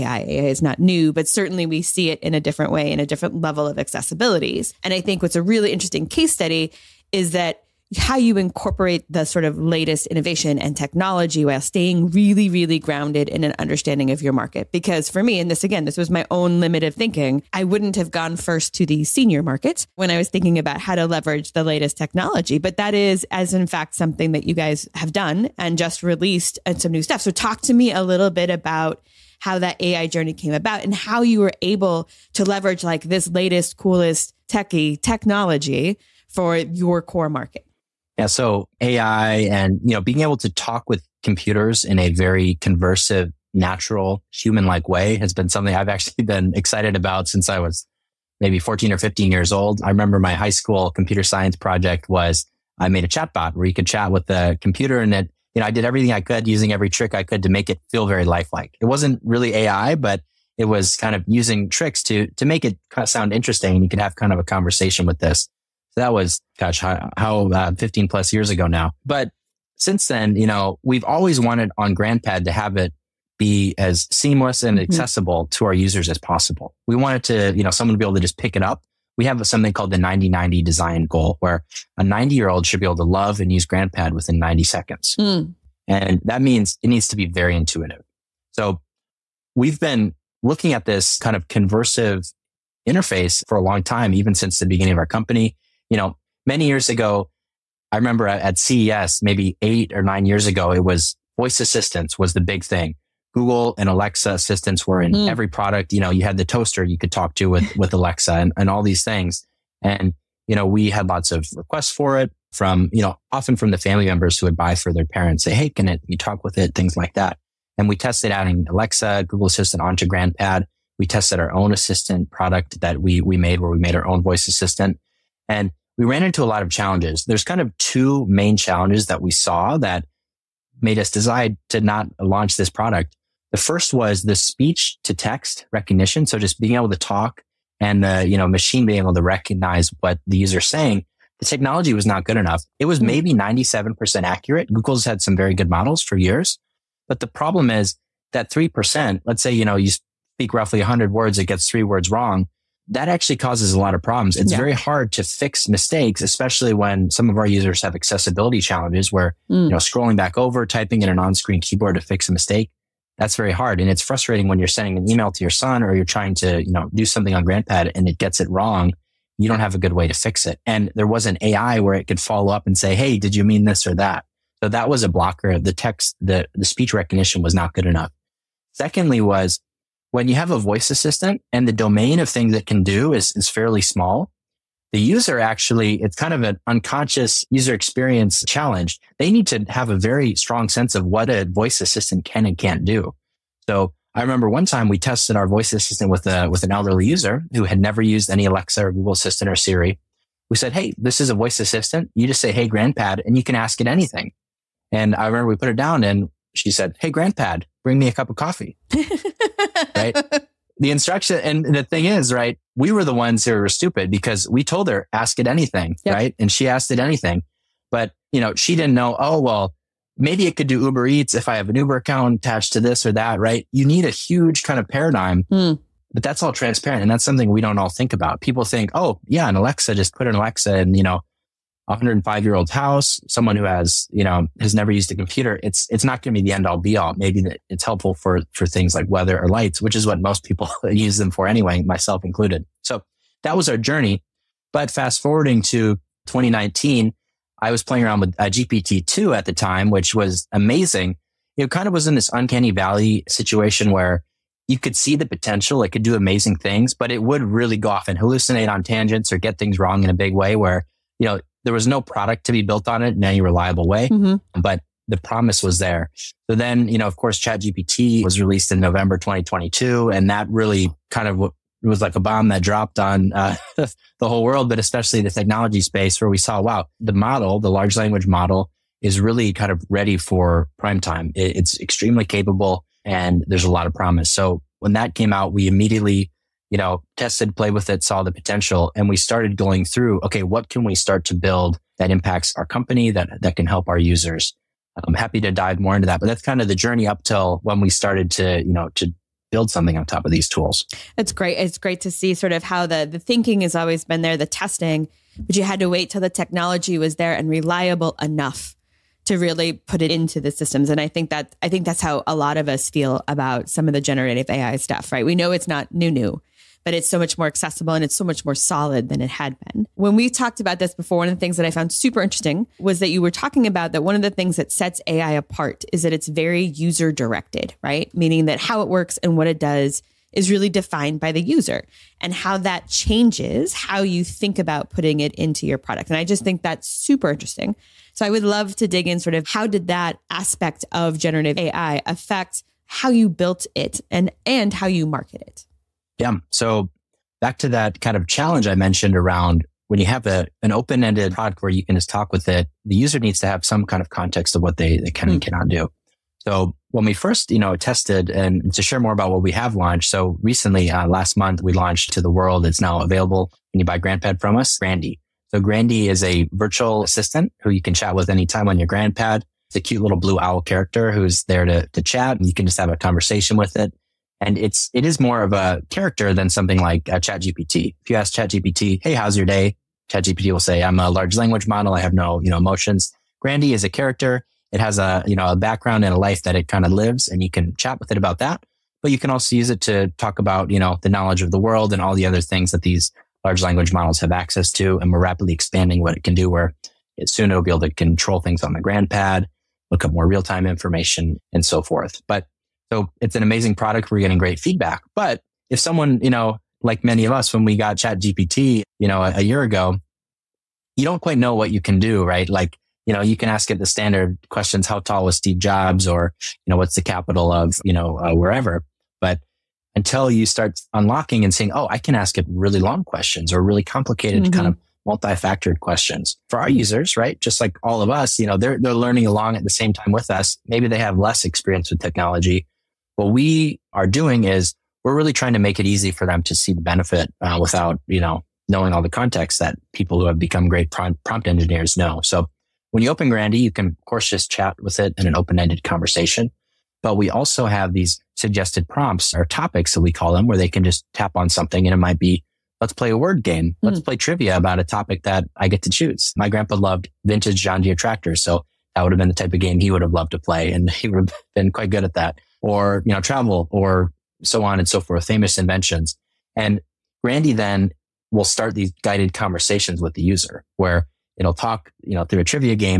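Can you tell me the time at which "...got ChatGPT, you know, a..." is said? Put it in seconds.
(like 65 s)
407 s.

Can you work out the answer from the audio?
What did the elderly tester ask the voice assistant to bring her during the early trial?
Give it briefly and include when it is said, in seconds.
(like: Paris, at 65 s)
a cup of coffee, at 208 s.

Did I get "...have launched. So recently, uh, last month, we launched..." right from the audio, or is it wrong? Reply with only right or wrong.
right.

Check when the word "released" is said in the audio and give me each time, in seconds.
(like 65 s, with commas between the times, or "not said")
26 s, 268 s.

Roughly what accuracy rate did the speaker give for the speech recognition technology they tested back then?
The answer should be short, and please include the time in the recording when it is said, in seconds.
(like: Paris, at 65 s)
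97%, at 143 s.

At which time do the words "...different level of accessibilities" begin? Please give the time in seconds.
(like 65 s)
3 s.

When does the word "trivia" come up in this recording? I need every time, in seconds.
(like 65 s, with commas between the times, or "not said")
454 s, 472 s.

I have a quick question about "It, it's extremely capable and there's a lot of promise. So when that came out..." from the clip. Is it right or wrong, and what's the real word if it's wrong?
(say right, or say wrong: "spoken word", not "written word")
right.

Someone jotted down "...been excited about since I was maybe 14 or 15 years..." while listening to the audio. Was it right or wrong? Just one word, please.
right.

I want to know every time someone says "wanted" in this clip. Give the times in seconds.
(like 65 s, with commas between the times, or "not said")
71 s, 76 s.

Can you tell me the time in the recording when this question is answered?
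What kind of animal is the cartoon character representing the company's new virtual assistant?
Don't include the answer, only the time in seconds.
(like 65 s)
370 s.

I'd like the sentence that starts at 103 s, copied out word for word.
Google and Alexa assistants were in mm.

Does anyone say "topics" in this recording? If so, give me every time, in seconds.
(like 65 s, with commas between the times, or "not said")
449 s, 454 s.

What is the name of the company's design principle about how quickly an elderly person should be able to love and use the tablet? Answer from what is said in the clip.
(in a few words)
90-90 design goal.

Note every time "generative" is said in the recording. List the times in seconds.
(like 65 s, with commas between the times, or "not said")
314 s, 341 s.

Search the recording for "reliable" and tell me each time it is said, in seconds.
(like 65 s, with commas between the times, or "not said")
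263 s, 307 s.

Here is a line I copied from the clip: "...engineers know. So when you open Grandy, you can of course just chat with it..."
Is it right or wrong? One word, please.
right.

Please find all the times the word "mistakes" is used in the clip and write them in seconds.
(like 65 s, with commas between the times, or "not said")
155 s, 162 s.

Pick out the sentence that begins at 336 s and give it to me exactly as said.
And I just think that's super interesting.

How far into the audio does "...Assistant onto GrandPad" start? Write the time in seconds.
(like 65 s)
119 s.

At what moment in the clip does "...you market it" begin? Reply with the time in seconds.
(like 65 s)
344 s.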